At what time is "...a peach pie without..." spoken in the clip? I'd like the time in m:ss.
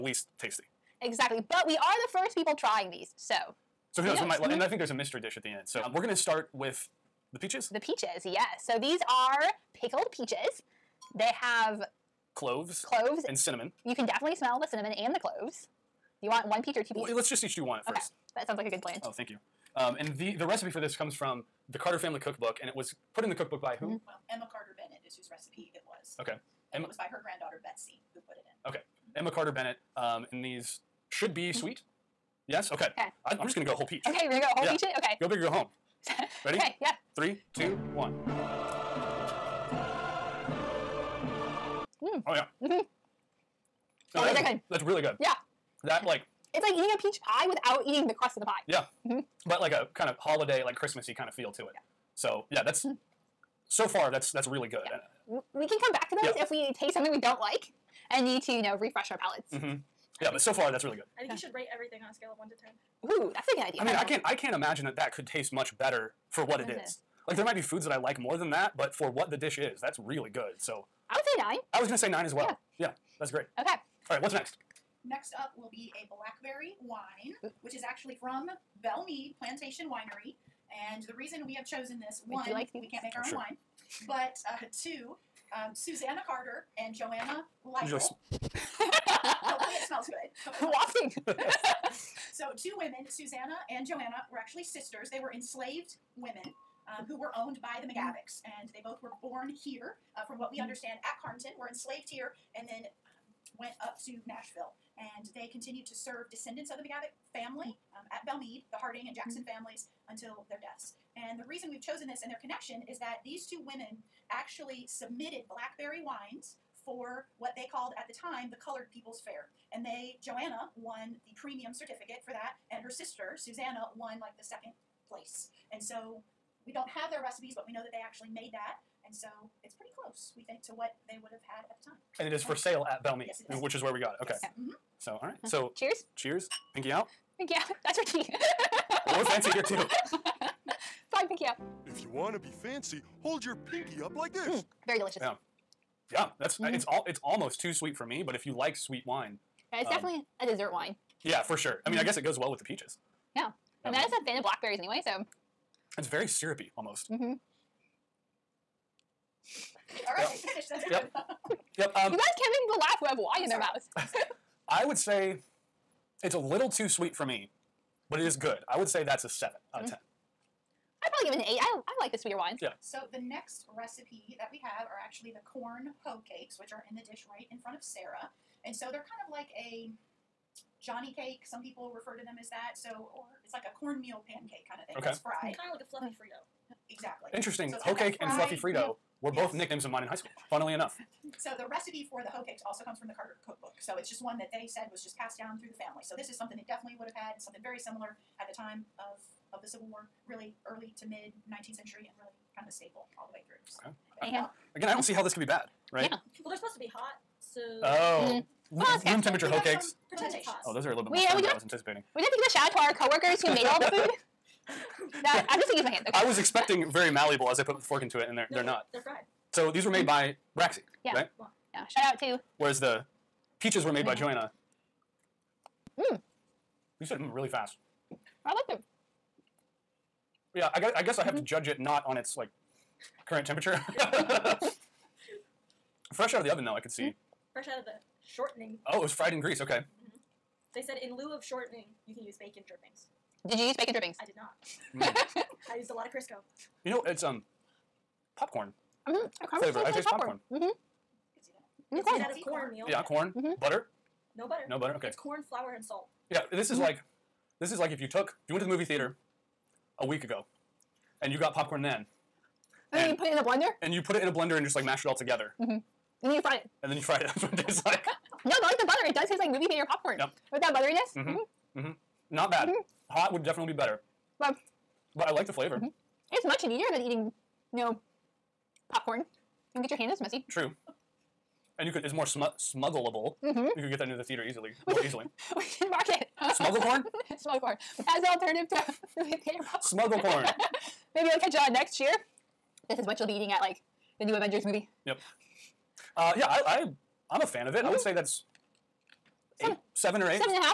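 0:46.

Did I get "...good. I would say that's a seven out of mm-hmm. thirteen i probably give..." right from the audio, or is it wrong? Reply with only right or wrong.
wrong.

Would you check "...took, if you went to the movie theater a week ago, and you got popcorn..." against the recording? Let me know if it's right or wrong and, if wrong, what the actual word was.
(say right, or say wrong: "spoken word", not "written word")
right.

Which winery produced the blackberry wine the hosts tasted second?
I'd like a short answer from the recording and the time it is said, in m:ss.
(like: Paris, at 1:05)
Belle Meade Plantation Winery, at 1:18.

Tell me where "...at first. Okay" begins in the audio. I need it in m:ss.
0:17.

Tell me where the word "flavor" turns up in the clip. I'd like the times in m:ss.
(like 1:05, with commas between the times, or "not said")
4:09, 4:35.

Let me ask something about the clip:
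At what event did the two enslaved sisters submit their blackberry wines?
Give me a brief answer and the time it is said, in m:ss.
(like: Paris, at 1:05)
Colored People's Fair, at 1:58.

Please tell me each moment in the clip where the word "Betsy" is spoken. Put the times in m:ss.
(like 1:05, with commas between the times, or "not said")
0:27.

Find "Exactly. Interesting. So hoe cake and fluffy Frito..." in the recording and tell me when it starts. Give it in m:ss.
3:06.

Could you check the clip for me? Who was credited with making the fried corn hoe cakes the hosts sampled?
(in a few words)
Braxy.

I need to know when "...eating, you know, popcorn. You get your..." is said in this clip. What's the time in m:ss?
4:36.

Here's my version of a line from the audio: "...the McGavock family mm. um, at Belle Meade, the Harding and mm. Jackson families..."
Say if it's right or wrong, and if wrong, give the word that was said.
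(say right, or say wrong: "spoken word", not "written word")
right.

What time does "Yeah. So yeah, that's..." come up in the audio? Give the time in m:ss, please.
0:51.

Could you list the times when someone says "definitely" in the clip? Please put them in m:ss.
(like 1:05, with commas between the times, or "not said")
0:14, 2:29, 3:16, 4:33.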